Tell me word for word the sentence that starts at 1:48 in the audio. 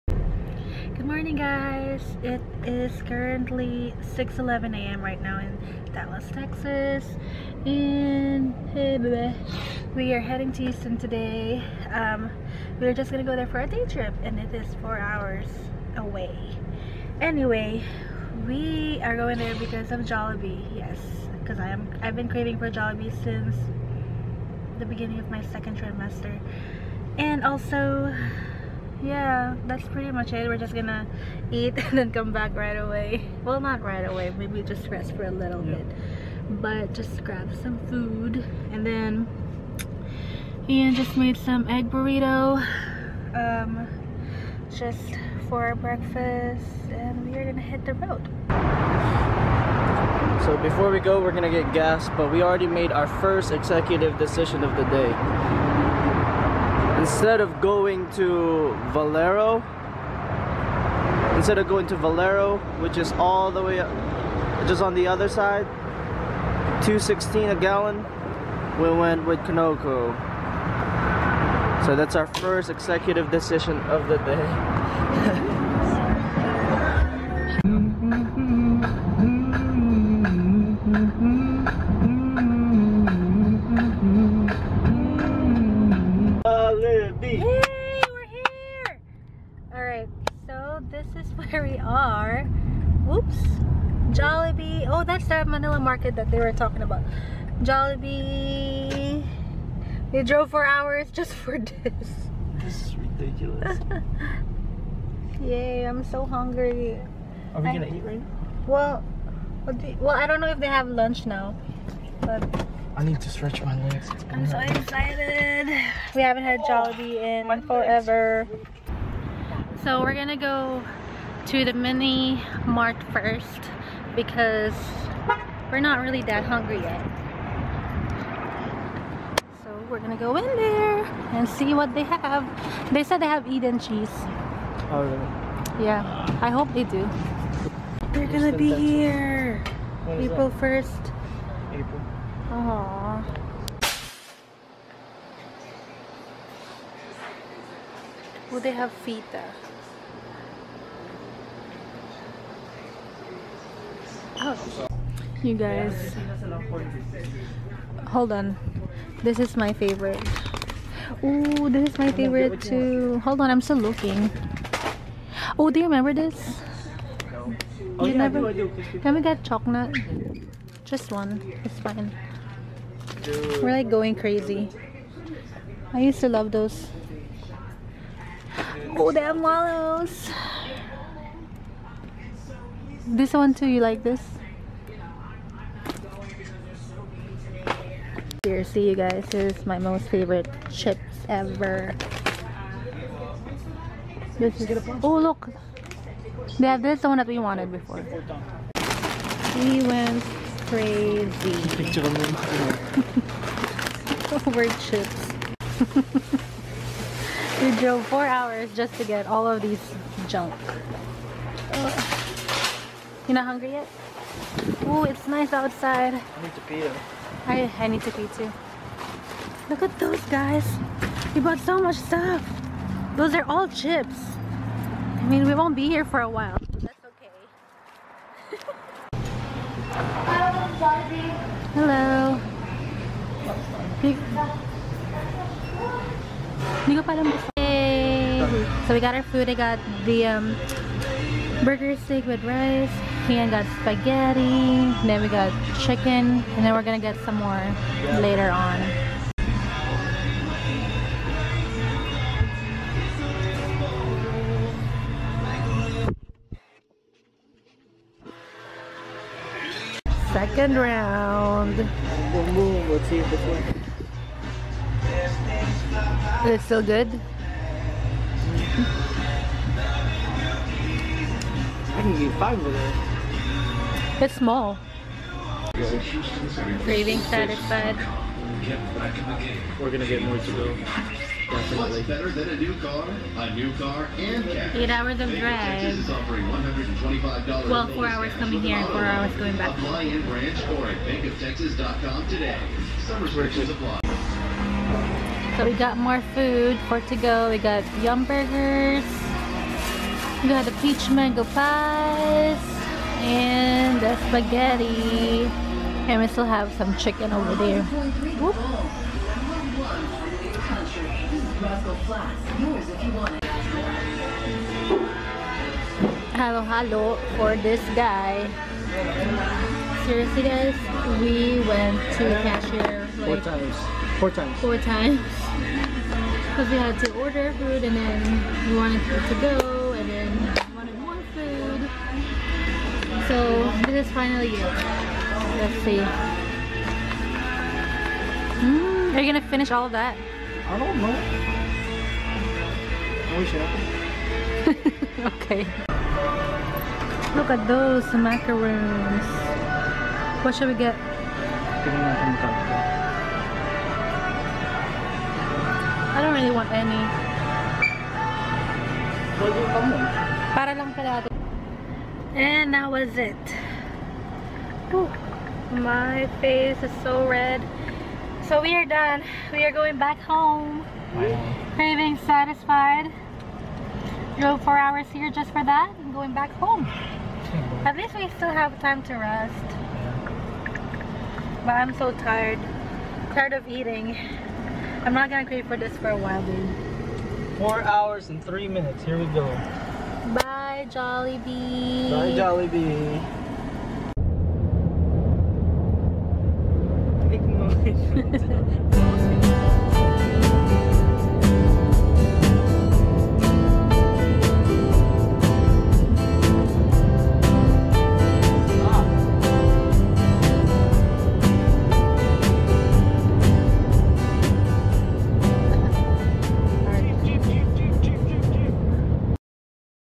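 Well, well, I don't know if they have lunch now, but.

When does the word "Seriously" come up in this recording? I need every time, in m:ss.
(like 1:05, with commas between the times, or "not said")
3:08, 5:20.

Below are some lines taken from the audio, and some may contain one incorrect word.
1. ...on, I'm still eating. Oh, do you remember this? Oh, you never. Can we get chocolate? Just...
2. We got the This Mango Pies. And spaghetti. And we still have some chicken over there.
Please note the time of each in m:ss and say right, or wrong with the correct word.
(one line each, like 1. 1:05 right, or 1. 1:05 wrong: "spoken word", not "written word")
1. 2:43 wrong: "looking", not "eating"
2. 5:00 wrong: "Peach", not "This".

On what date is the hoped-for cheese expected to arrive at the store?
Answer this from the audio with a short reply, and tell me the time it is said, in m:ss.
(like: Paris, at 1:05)
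April 1st, at 2:20.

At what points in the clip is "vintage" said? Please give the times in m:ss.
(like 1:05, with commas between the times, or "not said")
not said.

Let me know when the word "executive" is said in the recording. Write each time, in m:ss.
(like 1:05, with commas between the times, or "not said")
0:53, 1:12.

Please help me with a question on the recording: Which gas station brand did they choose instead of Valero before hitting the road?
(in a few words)
Conoco.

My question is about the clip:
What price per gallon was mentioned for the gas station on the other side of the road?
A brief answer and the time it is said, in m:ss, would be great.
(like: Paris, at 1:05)
216, at 1:06.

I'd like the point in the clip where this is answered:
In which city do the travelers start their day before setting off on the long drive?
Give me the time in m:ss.
0:05.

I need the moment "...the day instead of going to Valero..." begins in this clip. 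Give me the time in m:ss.
0:54.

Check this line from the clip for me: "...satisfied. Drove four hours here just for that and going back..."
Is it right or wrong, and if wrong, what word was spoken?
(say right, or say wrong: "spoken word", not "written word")
right.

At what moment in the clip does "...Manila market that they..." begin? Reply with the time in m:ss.
1:35.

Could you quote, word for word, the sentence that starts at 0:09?
We are heading to Houston today.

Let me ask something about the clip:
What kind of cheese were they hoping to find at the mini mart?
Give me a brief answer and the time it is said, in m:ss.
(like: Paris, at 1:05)
Eden cheese, at 2:13.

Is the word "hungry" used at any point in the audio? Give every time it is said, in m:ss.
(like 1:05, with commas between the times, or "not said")
1:46, 2:06, 3:33.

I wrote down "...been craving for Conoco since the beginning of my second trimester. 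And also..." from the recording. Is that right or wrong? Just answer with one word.
wrong.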